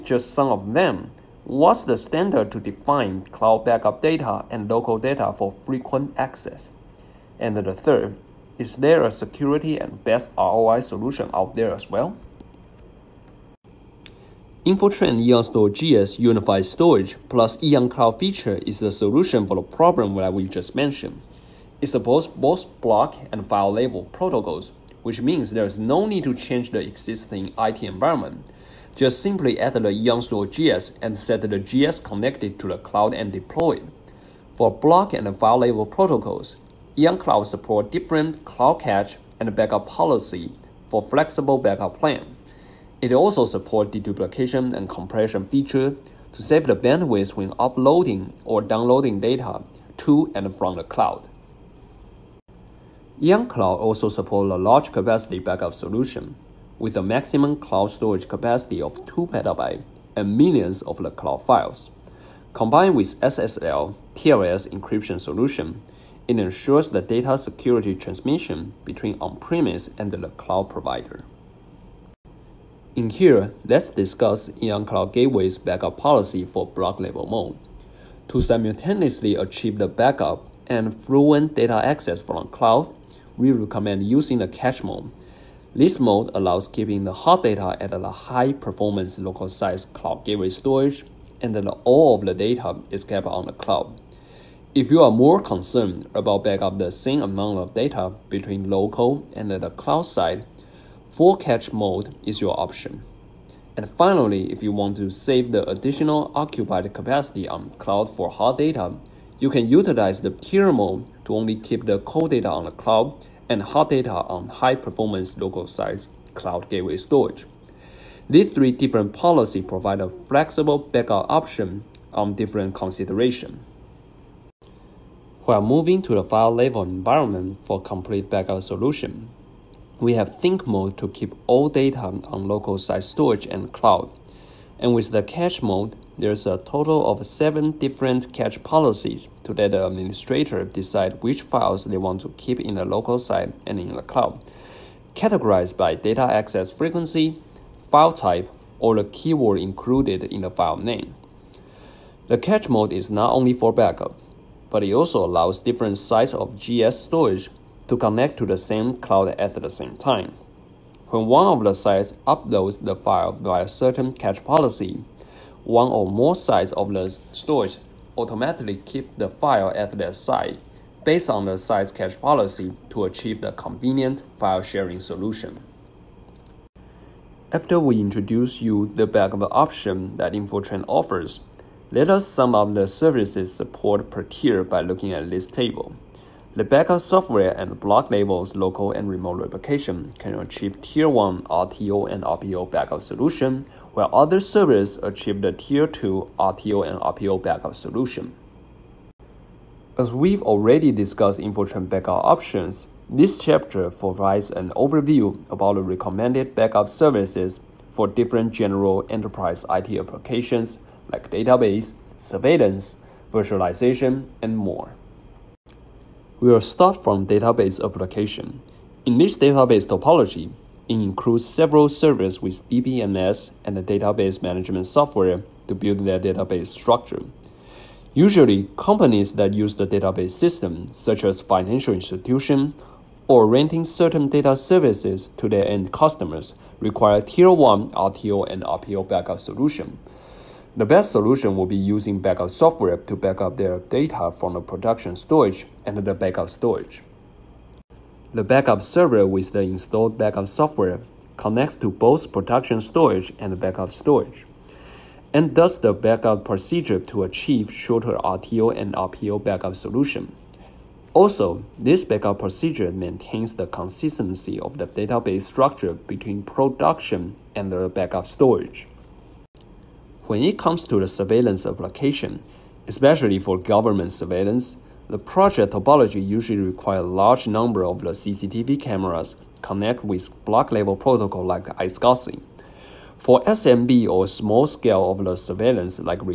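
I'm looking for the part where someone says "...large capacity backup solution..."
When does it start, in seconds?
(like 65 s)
54 s.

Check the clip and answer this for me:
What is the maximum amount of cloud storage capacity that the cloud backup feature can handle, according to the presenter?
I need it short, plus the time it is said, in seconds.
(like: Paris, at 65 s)
2 petabytes, at 59 s.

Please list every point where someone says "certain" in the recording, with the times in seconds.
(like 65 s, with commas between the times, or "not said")
163 s, 233 s.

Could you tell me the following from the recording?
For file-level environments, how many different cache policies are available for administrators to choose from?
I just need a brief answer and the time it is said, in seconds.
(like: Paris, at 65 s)
7, at 137 s.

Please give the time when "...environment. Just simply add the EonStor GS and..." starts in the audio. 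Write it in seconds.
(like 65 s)
27 s.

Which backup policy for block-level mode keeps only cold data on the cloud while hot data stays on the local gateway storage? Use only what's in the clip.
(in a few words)
tier mode.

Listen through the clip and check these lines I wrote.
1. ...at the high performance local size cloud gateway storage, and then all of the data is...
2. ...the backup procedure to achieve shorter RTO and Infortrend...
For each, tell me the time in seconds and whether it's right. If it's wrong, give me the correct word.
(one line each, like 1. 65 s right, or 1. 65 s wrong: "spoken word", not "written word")
1. 87 s right
2. 255 s wrong: "RPO", not "Infortrend".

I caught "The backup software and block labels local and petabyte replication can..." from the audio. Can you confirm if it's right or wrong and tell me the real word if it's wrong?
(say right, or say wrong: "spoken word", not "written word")
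wrong: "remote", not "petabyte".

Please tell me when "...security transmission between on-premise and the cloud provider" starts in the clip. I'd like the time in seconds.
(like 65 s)
67 s.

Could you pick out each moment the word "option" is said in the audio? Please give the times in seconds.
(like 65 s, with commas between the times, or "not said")
102 s, 121 s, 179 s, 202 s.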